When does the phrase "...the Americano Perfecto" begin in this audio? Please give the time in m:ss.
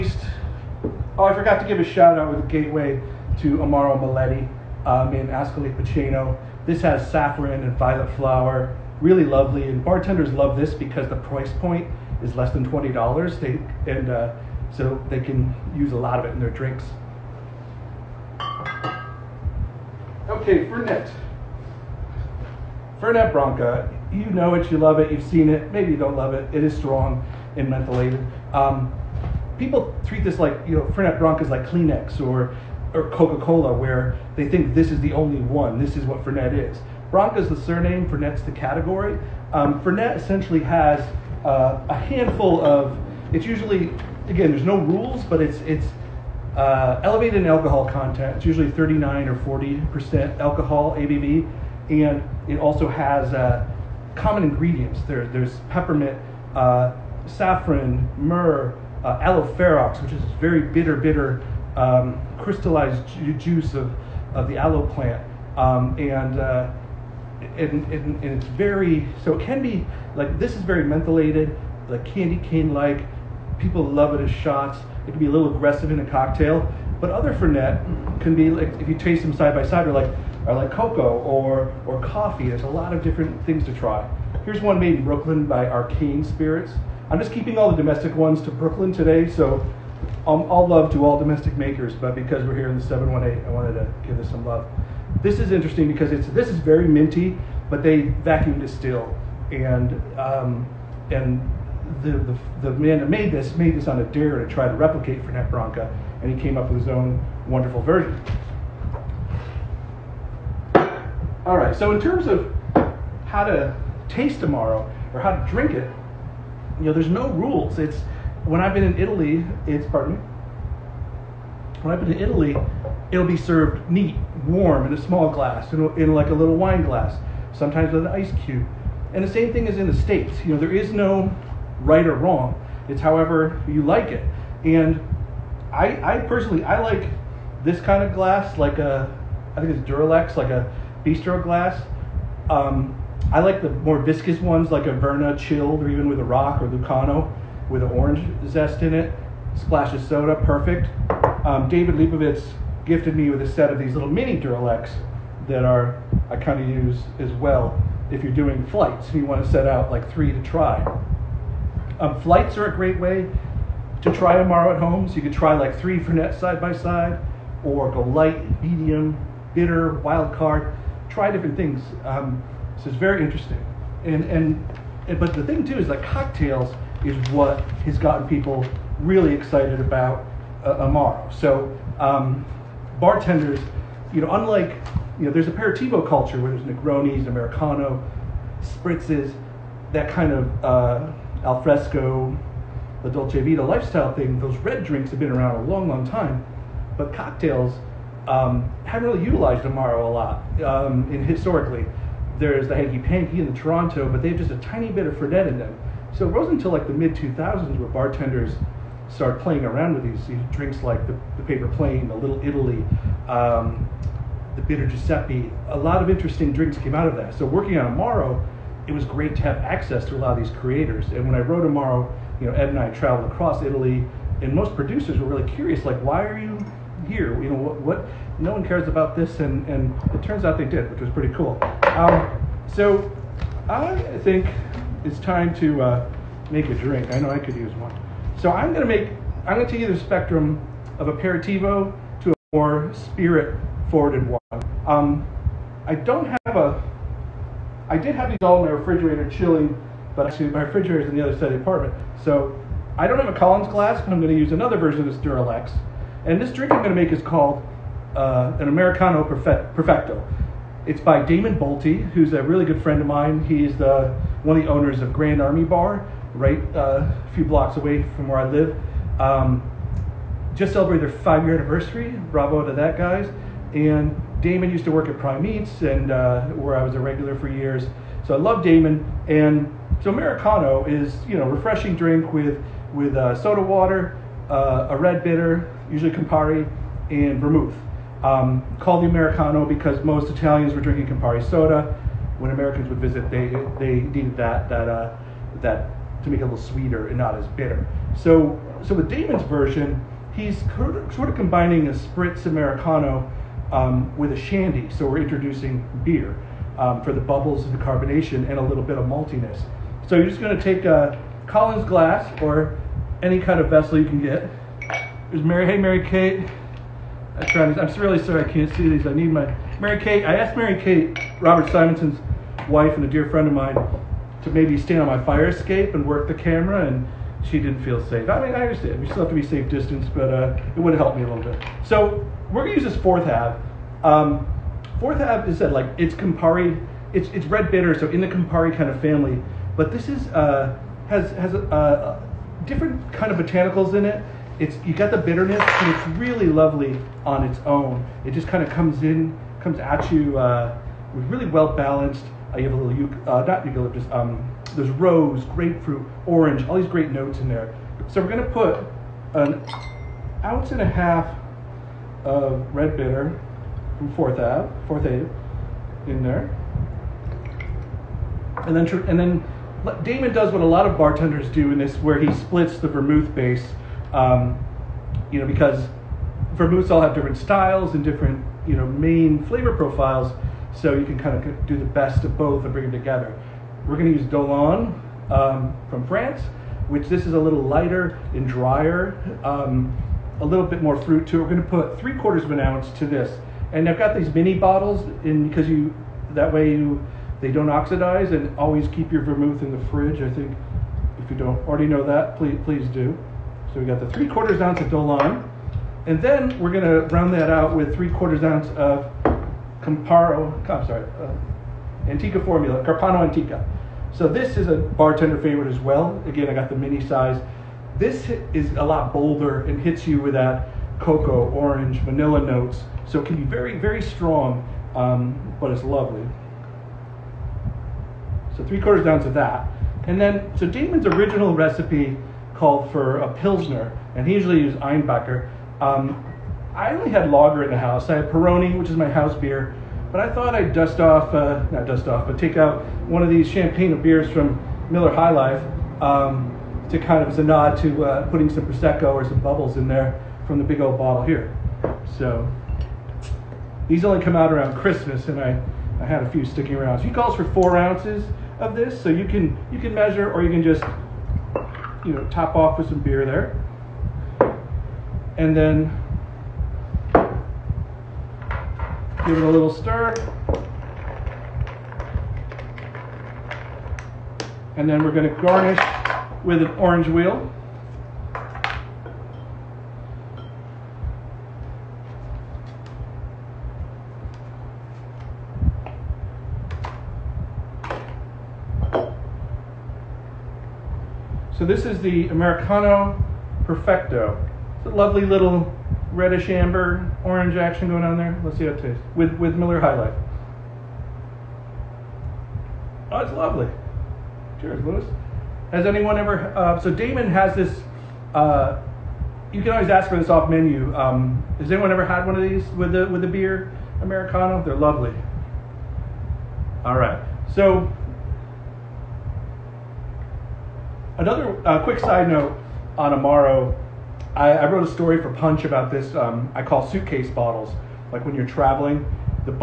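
8:12.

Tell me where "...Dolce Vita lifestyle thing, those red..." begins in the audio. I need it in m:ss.
3:13.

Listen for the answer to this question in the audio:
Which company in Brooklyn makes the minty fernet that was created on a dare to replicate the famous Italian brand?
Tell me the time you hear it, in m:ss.
1:25.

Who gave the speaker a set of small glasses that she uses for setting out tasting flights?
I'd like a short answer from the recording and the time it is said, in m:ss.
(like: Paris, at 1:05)
David Lebovitz, at 2:31.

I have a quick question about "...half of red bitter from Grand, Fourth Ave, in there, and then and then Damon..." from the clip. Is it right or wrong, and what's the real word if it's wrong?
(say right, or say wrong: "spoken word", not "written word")
wrong: "Forthave", not "Grand".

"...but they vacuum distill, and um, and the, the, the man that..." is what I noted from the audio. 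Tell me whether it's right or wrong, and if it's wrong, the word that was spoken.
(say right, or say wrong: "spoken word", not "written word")
right.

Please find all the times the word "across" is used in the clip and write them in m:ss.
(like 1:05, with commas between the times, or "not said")
3:43.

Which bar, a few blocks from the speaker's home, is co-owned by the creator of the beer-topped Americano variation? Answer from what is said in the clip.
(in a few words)
Grand Army Bar.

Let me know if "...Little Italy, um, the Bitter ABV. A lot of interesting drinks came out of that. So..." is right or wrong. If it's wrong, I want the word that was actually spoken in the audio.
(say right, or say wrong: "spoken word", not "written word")
wrong: "Giuseppe", not "ABV".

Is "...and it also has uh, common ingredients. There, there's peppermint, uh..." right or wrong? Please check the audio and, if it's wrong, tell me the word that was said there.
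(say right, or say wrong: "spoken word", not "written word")
right.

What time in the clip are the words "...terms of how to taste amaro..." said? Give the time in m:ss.
1:52.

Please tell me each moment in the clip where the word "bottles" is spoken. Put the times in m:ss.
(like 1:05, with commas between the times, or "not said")
6:34, 7:30, 8:47.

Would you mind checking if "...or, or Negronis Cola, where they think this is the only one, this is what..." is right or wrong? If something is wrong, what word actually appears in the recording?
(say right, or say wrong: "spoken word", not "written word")
wrong: "Coca", not "Negronis".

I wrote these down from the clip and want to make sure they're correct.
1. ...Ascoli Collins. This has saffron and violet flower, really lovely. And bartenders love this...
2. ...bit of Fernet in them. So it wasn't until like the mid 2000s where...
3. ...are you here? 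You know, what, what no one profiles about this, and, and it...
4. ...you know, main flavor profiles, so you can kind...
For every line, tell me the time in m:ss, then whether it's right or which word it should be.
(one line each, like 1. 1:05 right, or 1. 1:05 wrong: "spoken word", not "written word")
1. 0:05 wrong: "Piceno", not "Collins"
2. 3:24 right
3. 3:46 wrong: "cares", not "profiles"
4. 6:18 right.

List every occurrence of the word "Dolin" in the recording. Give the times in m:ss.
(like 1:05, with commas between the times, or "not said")
6:24, 6:44.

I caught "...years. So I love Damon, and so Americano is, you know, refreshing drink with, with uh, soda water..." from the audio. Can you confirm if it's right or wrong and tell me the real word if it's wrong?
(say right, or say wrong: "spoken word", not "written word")
right.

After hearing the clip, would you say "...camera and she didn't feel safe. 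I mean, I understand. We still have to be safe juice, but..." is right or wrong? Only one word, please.
wrong.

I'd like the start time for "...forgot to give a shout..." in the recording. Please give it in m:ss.
0:01.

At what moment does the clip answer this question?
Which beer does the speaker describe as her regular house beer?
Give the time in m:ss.
7:18.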